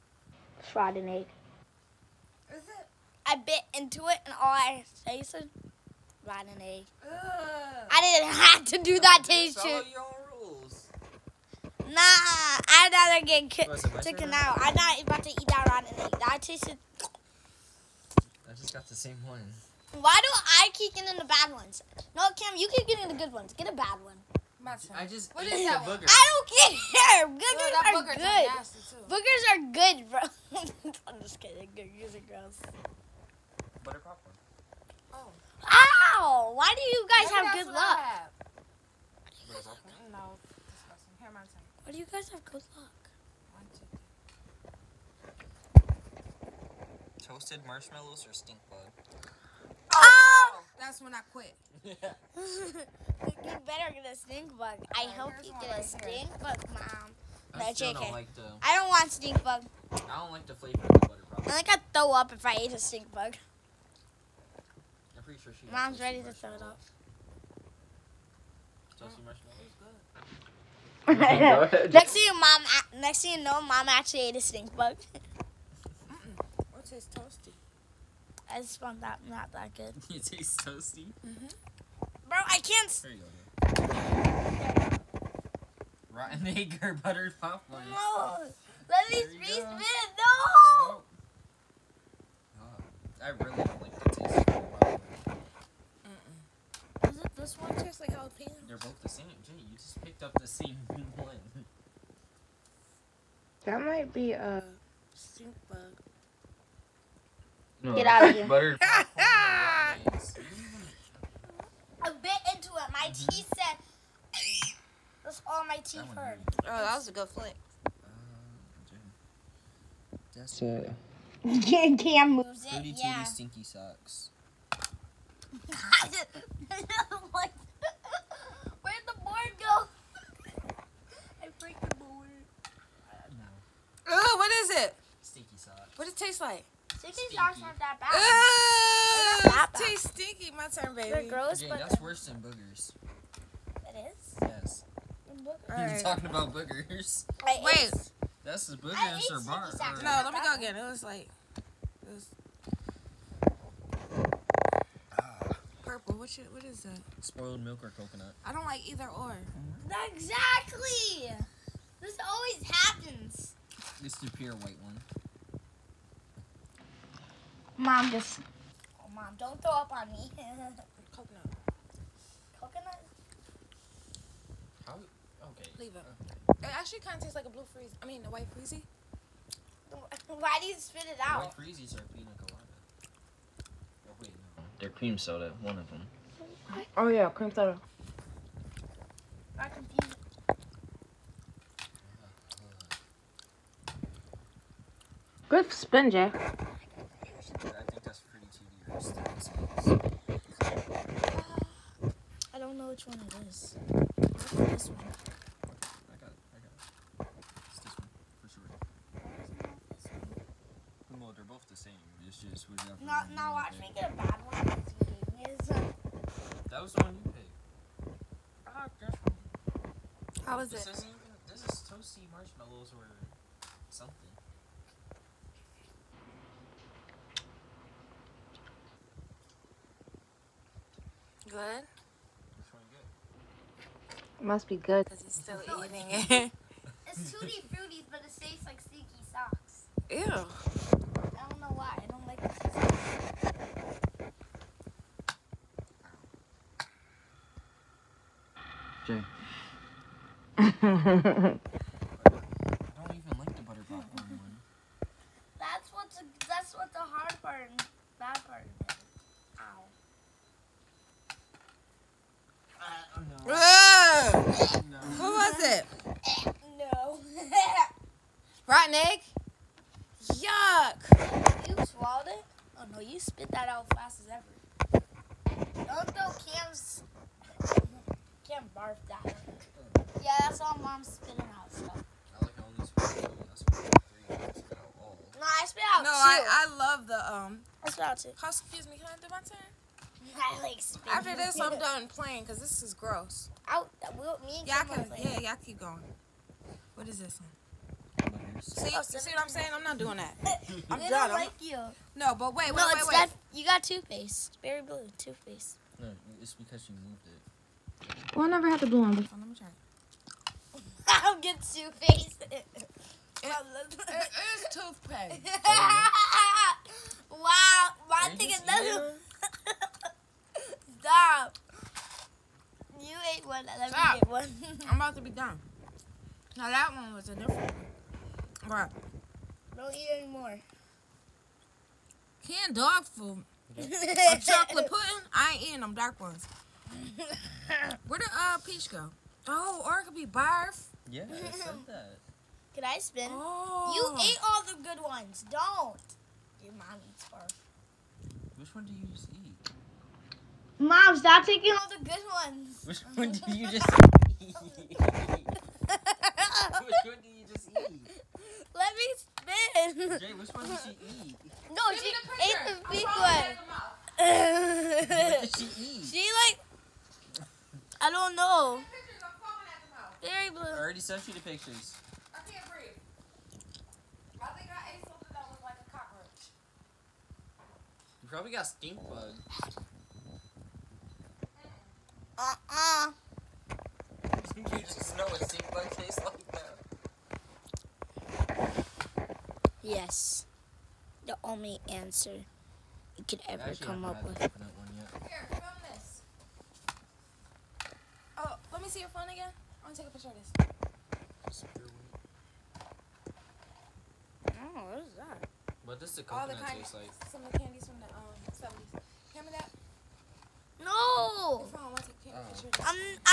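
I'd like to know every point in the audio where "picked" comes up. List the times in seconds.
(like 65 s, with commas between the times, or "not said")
100 s, 217 s.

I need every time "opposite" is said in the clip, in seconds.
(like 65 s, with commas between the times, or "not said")
not said.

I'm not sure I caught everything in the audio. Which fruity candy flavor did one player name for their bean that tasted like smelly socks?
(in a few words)
Tutti Fruities.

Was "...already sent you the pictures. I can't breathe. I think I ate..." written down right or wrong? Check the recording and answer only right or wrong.
right.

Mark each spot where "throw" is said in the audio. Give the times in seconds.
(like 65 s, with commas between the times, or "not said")
61 s, 66 s, 169 s, 276 s.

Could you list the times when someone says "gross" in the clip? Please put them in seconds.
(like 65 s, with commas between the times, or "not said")
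32 s, 141 s, 292 s.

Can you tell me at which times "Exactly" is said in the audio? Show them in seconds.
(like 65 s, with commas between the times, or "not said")
160 s.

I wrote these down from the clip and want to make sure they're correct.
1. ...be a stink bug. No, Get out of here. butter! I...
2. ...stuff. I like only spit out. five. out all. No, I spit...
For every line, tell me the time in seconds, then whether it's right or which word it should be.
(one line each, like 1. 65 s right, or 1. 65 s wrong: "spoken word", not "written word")
1. 104 s right
2. 281 s wrong: "three", not "five".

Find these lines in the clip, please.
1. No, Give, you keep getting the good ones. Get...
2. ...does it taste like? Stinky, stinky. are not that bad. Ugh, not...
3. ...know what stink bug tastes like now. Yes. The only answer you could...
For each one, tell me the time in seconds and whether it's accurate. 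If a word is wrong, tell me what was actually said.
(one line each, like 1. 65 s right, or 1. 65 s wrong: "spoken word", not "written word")
1. 22 s wrong: "Cam", not "Give"
2. 136 s right
3. 385 s right.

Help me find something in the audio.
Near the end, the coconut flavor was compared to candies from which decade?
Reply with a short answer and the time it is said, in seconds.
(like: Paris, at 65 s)
70s, at 408 s.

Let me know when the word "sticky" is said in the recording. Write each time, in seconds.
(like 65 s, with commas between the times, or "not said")
238 s.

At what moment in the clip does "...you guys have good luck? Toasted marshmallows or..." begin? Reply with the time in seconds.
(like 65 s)
41 s.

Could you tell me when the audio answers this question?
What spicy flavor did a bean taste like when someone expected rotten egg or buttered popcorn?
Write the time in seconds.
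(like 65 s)
98 s.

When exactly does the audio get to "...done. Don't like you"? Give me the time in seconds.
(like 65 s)
301 s.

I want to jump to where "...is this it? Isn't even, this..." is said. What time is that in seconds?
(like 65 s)
220 s.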